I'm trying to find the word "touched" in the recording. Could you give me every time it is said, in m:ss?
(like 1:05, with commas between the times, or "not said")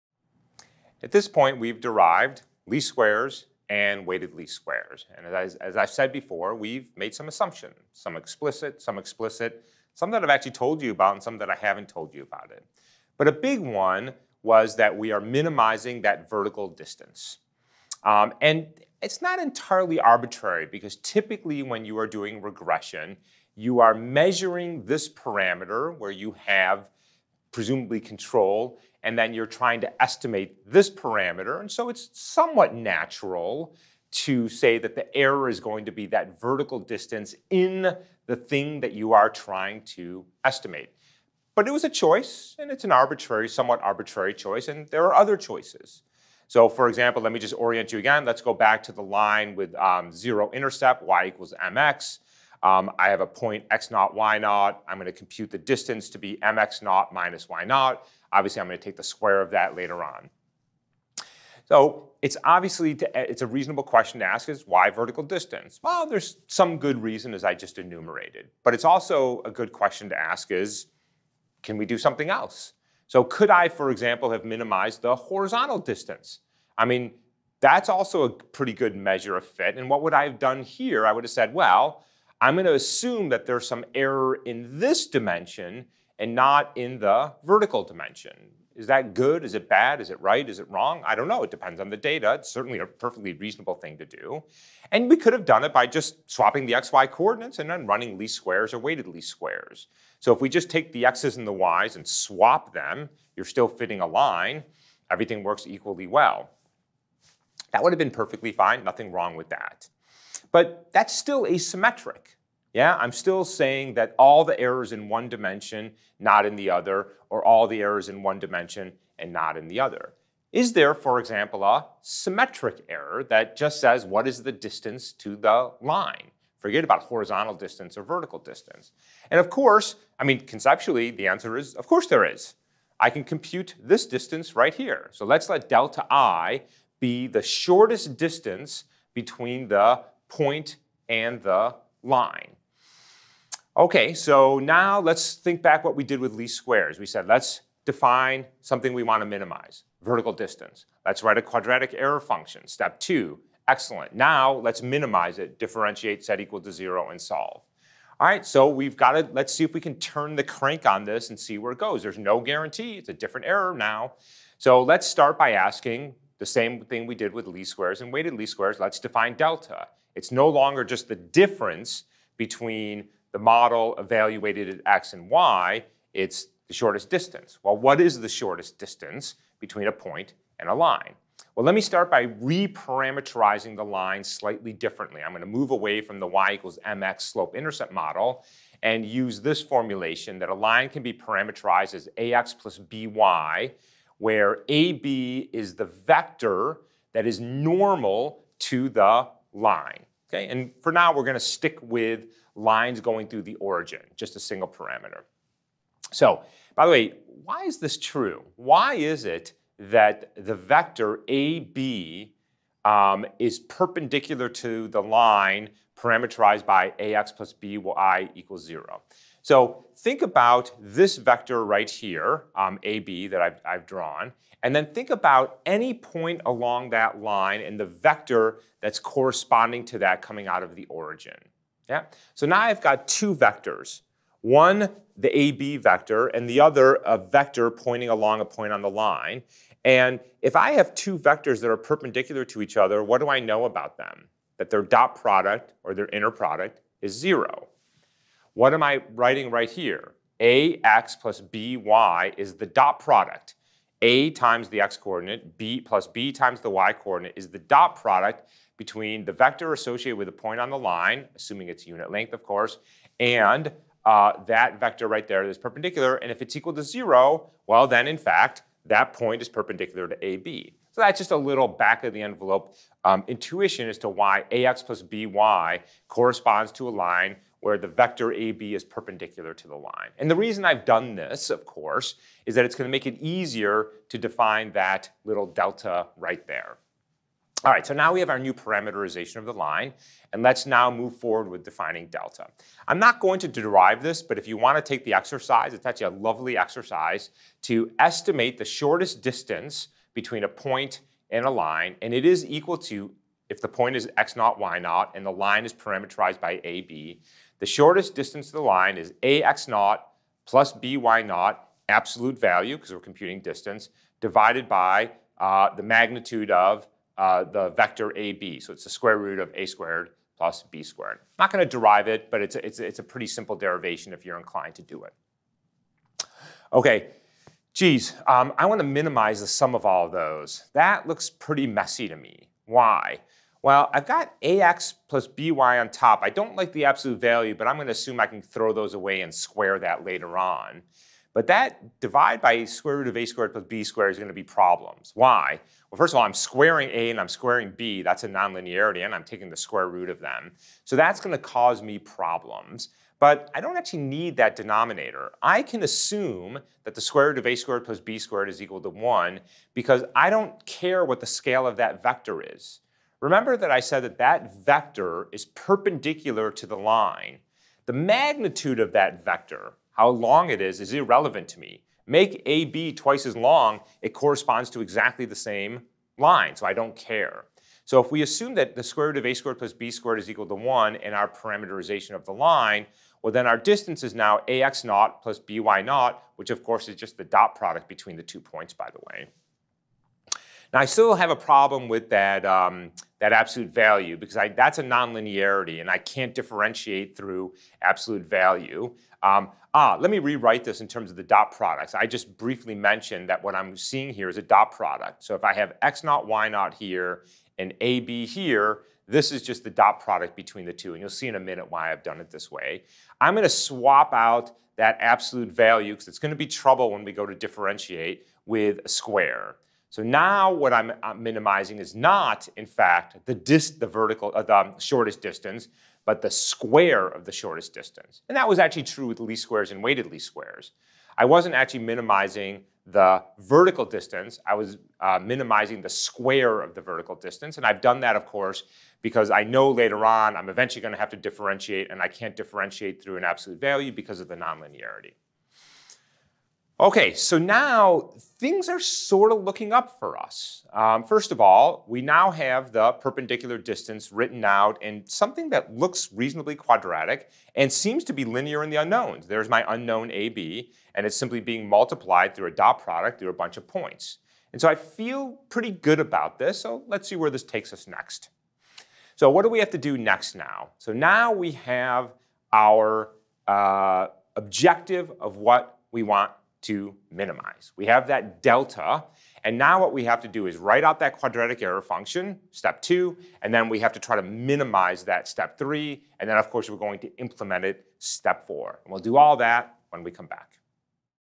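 not said.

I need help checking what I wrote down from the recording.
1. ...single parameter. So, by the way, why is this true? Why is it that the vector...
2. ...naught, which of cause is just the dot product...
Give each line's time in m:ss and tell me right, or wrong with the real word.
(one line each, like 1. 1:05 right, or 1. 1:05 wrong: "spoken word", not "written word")
1. 3:24 right
2. 6:25 wrong: "course", not "cause".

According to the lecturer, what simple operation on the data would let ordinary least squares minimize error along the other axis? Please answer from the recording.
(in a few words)
swapping the xy coordinates.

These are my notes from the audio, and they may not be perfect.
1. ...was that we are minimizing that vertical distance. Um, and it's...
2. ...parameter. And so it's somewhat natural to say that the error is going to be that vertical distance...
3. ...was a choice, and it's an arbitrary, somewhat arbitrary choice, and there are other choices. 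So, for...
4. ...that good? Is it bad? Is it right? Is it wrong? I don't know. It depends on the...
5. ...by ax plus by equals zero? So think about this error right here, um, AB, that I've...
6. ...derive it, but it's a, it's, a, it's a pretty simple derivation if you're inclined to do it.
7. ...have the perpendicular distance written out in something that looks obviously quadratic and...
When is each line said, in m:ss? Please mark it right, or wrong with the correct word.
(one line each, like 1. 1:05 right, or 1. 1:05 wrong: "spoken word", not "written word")
1. 0:14 right
2. 0:30 right
3. 0:41 right
4. 1:28 right
5. 3:36 wrong: "vector", not "error"
6. 5:21 right
7. 7:32 wrong: "reasonably", not "obviously".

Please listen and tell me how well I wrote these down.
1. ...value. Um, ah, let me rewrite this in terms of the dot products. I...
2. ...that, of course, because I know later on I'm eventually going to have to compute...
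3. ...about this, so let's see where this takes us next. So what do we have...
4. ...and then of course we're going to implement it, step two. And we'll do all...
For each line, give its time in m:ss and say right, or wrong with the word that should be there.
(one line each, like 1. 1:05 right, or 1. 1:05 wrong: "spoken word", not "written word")
1. 6:38 right
2. 7:17 wrong: "differentiate", not "compute"
3. 7:45 right
4. 8:06 wrong: "four", not "two".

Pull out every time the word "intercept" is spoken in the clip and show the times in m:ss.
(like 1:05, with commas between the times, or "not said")
0:50, 3:07.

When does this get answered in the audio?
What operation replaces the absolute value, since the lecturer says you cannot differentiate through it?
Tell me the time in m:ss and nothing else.
6:58.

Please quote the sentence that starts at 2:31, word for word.
Let's write a quadratic error function, step two.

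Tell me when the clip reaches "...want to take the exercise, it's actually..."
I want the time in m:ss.
4:54.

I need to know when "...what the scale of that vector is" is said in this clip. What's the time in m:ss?
6:01.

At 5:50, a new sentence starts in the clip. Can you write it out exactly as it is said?
So that's going to cause me problems.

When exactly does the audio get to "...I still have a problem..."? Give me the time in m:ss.
6:30.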